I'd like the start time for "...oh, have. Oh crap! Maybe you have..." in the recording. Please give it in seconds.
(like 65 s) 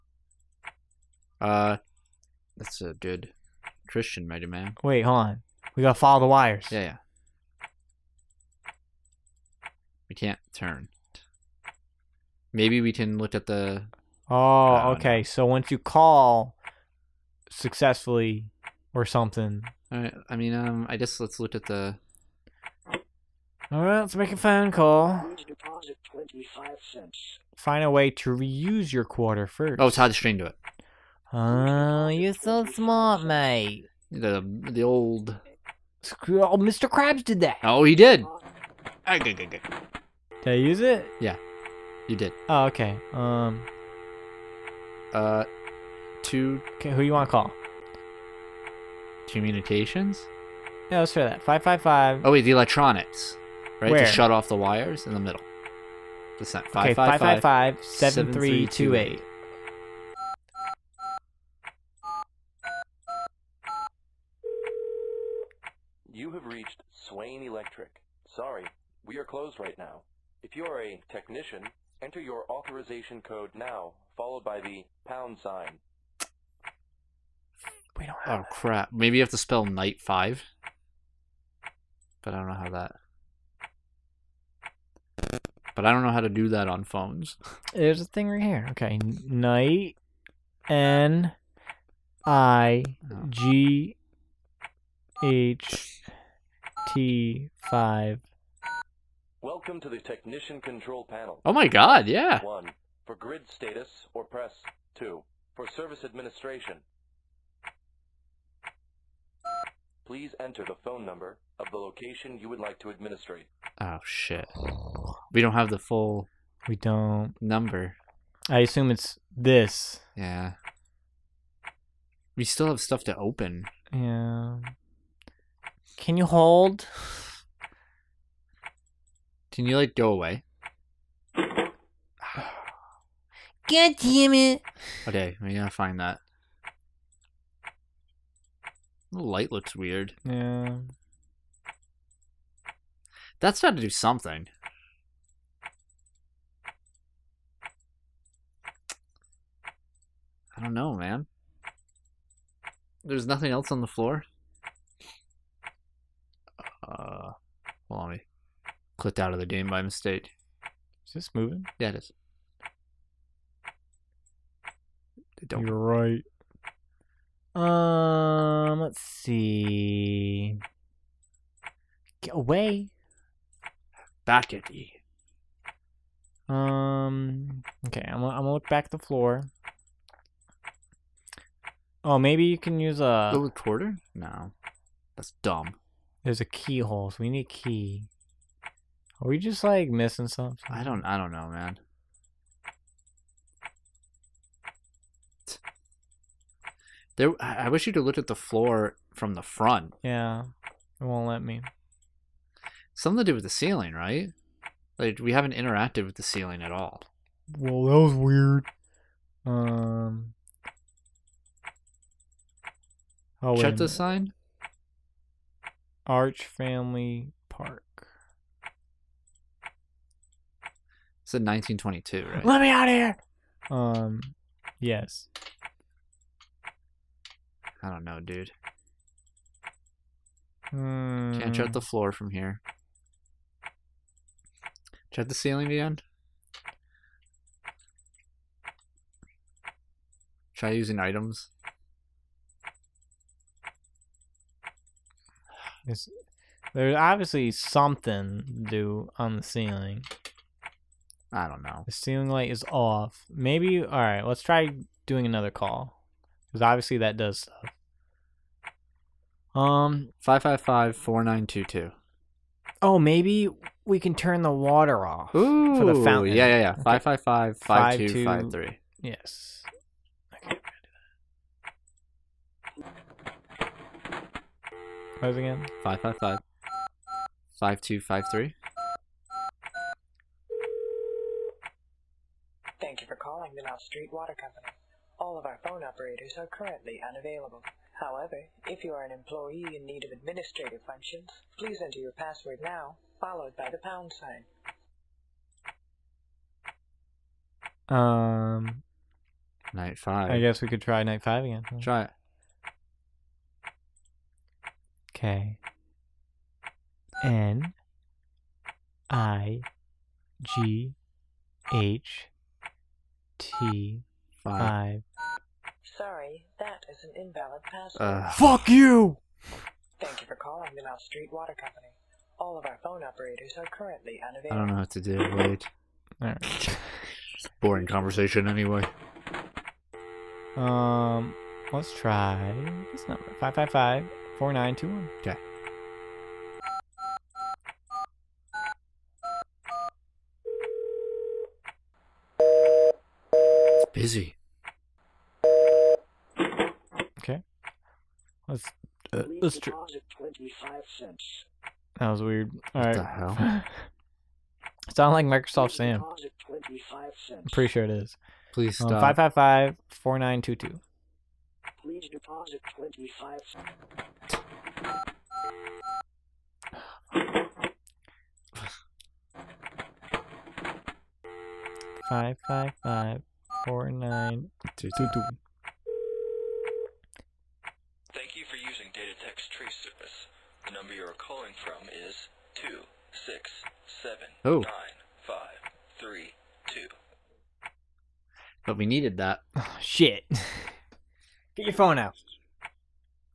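78 s.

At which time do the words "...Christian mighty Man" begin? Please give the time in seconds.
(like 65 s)
3 s.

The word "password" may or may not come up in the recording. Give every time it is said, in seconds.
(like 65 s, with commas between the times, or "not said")
292 s, 317 s.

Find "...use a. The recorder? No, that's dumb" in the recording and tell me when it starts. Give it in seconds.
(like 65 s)
182 s.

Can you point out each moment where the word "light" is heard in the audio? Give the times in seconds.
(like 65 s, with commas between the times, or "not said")
139 s, 252 s.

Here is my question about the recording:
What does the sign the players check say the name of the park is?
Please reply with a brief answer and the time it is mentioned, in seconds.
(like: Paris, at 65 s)
Arch Family Park, at 216 s.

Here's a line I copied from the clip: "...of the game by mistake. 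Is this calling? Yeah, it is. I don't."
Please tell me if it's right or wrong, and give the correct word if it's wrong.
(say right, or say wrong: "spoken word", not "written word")
wrong: "moving", not "calling".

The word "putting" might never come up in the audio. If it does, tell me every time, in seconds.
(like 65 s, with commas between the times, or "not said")
not said.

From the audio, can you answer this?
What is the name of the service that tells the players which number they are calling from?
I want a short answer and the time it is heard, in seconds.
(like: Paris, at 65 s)
Data Trace Service, at 378 s.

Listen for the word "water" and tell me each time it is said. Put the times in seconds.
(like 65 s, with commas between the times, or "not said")
264 s, 284 s, 321 s.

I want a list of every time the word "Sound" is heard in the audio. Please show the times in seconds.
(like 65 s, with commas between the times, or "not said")
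354 s.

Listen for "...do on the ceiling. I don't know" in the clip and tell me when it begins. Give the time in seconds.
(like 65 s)
248 s.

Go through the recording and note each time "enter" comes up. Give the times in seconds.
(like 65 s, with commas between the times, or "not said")
72 s, 110 s, 291 s.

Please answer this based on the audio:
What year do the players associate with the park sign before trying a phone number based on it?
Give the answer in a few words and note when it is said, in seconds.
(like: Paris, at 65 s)
1922, at 221 s.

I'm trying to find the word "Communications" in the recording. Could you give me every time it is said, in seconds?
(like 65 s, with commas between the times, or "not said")
49 s.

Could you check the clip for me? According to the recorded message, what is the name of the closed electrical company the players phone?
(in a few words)
Swain Electric.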